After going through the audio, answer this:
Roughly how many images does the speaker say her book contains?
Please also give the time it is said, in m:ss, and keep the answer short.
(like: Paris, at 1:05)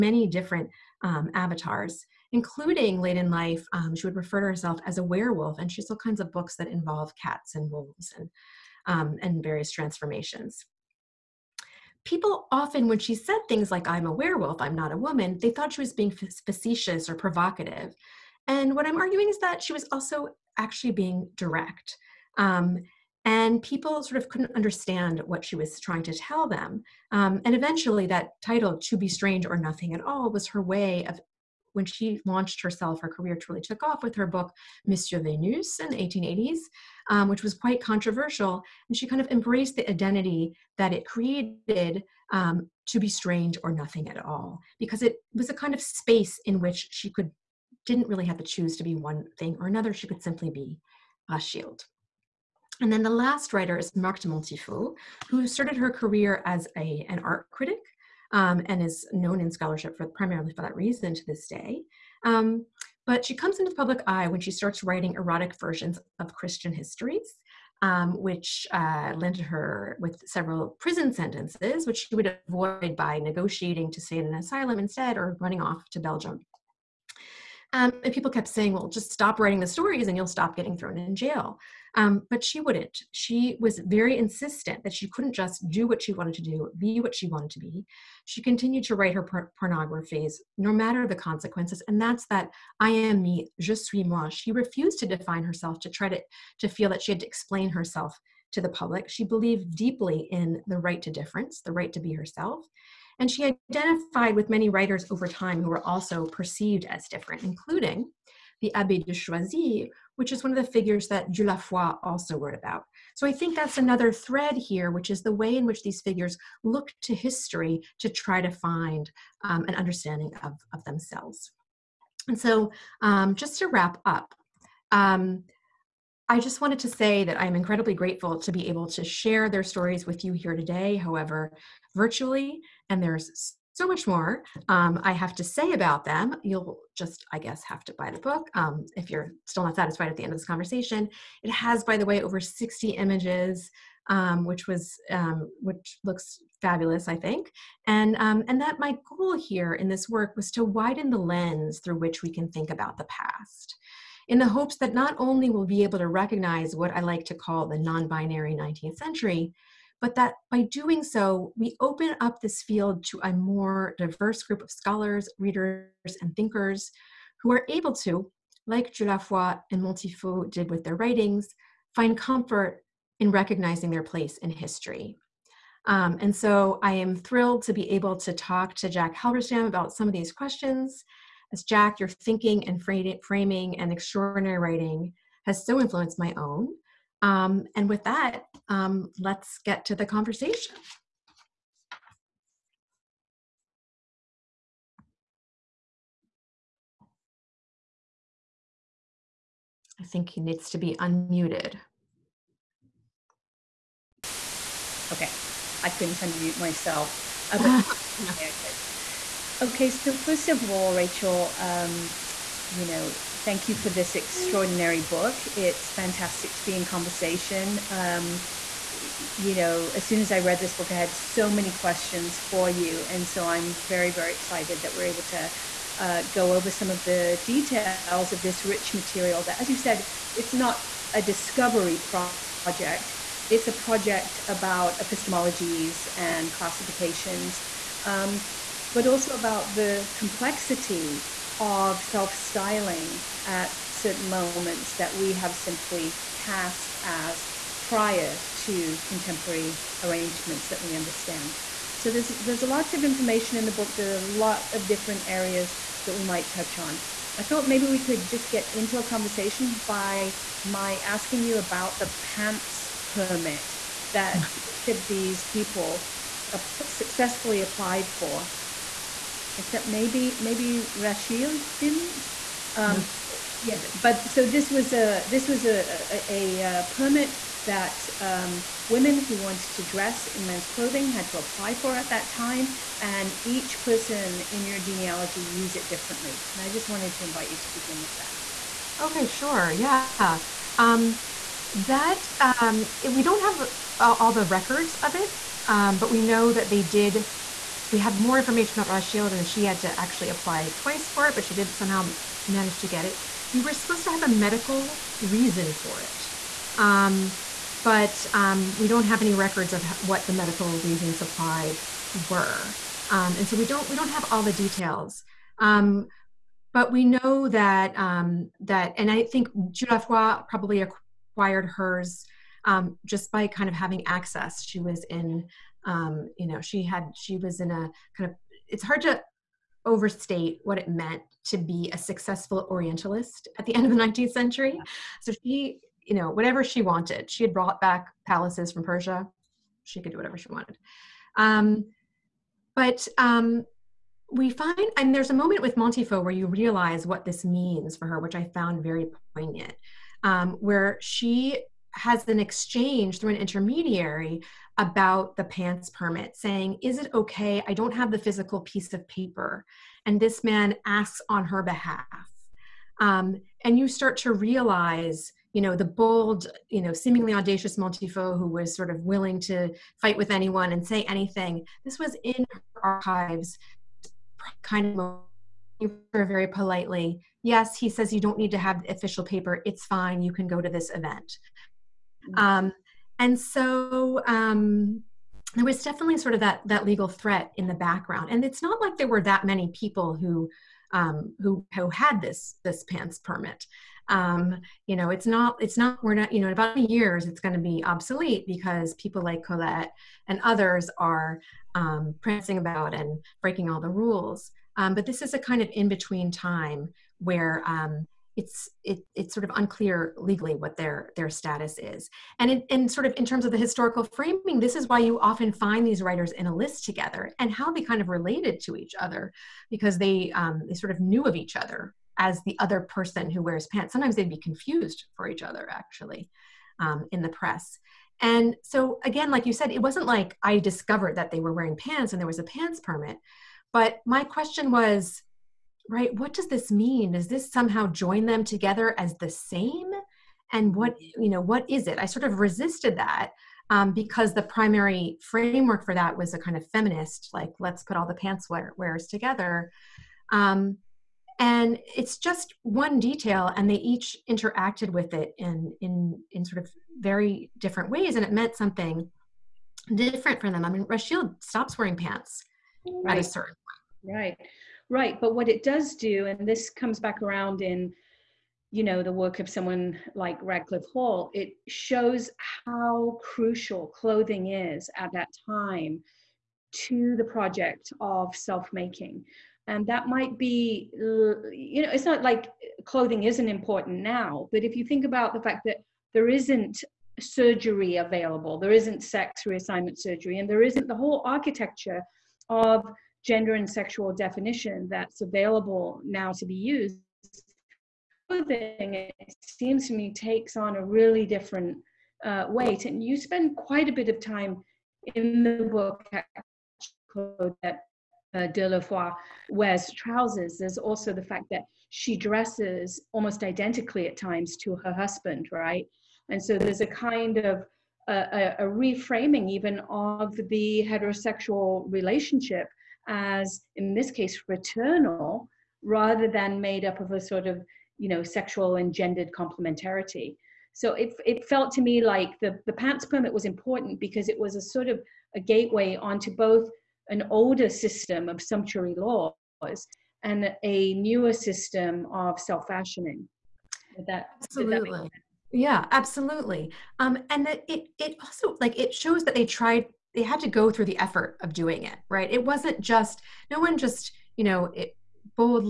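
Over 60, at 2:22.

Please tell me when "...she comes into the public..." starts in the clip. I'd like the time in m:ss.
1:03.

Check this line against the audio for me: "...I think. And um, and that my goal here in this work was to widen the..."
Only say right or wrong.
right.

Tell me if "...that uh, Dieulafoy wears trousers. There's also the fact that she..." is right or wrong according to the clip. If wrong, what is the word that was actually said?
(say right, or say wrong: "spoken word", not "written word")
right.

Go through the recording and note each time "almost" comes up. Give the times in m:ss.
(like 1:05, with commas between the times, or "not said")
8:33.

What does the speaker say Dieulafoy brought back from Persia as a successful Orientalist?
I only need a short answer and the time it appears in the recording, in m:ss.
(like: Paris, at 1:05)
Palaces, at 5:38.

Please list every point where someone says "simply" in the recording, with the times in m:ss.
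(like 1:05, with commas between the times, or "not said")
0:50, 4:05.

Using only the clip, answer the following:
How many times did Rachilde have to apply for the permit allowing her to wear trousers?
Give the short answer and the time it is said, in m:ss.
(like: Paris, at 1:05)
Twice, at 5:00.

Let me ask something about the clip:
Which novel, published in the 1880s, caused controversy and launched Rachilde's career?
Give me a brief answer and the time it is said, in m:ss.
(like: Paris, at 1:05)
Monsieur Venus, at 0:34.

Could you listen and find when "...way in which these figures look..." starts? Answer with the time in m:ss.
1:55.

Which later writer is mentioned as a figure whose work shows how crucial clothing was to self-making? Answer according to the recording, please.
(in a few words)
Radclyffe Hall.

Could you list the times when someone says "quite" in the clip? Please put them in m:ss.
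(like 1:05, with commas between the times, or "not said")
0:37, 8:23.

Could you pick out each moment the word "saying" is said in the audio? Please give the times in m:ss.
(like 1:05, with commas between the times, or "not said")
1:18, 5:56.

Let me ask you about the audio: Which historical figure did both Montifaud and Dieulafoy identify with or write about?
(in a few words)
Abbé de Choisy.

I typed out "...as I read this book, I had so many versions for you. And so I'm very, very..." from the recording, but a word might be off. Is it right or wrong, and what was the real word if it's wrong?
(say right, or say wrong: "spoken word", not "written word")
wrong: "questions", not "versions".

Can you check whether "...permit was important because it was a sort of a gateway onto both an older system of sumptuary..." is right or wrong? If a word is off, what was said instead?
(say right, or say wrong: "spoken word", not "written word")
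right.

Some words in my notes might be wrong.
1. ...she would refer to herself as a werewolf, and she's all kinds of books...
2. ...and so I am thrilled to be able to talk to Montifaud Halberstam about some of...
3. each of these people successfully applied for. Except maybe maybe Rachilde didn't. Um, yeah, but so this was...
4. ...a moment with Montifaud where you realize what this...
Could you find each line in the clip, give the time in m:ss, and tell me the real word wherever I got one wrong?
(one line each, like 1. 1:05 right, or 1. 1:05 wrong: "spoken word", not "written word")
1. 0:03 right
2. 2:56 wrong: "Jack", not "Montifaud"
3. 4:24 right
4. 5:45 right.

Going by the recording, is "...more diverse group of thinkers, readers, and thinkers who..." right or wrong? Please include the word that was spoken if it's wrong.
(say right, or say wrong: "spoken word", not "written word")
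wrong: "scholars", not "thinkers".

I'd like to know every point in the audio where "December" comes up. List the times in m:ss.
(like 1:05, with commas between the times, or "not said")
not said.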